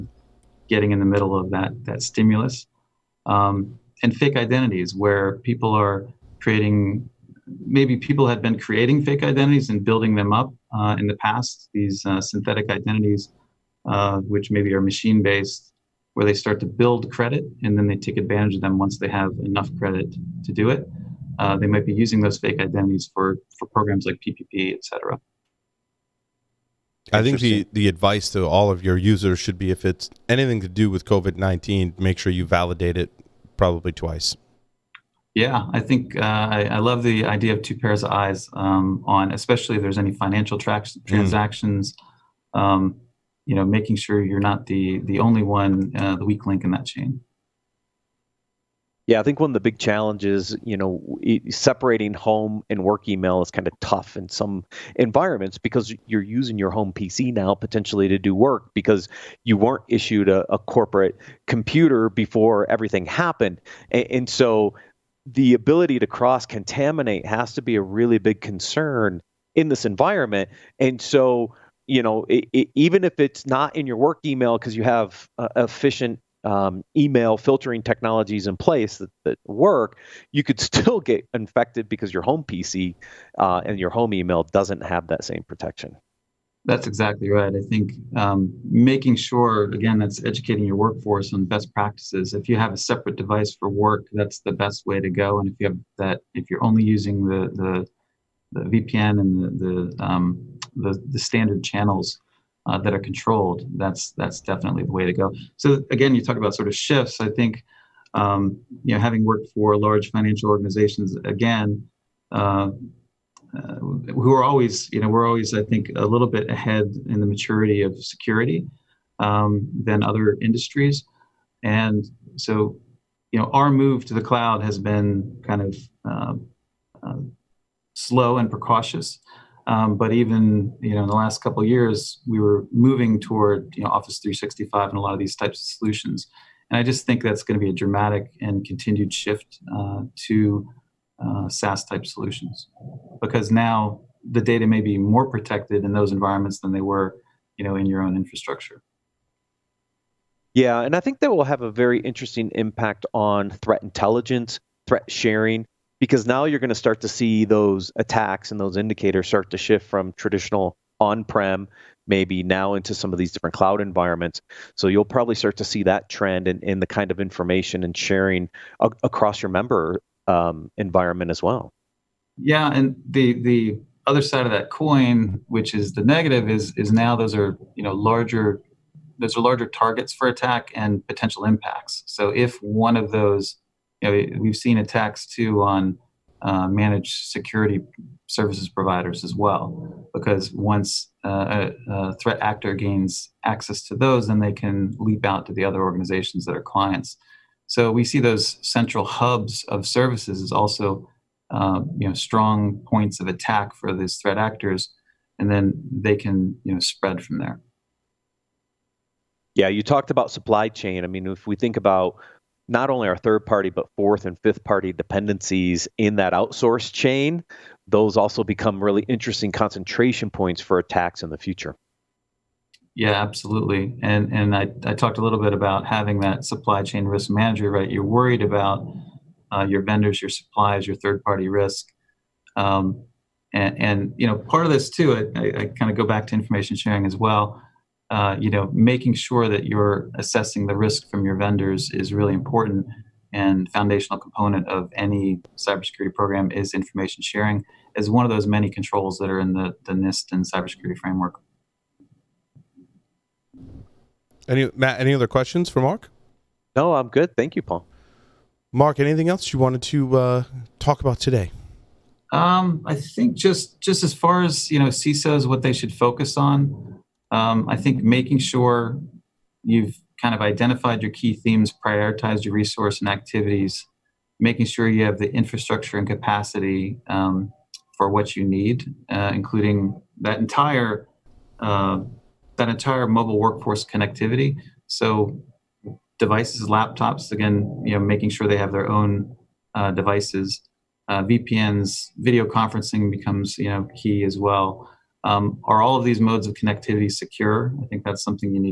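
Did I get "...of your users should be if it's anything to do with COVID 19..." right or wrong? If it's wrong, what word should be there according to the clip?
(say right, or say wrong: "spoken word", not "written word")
right.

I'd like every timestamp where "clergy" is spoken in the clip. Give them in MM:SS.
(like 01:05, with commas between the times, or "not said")
not said.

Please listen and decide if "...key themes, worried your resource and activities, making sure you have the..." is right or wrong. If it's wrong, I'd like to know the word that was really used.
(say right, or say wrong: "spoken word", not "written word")
wrong: "prioritized", not "worried".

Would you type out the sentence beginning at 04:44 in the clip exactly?
So devices, laptops, again, you know, making sure they have their own uh, devices.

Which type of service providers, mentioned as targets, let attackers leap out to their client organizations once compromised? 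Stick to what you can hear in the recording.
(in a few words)
Managed security services providers.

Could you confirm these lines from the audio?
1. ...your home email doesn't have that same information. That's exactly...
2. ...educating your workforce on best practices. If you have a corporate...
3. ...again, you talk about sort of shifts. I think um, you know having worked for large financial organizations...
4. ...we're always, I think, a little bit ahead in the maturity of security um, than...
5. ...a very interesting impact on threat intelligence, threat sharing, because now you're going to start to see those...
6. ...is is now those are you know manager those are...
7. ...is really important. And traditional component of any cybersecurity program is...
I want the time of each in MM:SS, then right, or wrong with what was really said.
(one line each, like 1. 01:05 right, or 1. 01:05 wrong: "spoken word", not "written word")
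1. 01:23 wrong: "protection", not "information"
2. 01:30 wrong: "separate", not "corporate"
3. 01:45 right
4. 01:55 right
5. 02:31 right
6. 02:56 wrong: "larger", not "manager"
7. 04:01 wrong: "foundational", not "traditional".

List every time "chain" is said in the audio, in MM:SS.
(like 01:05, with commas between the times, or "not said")
00:46, 03:30, 03:36, 03:46.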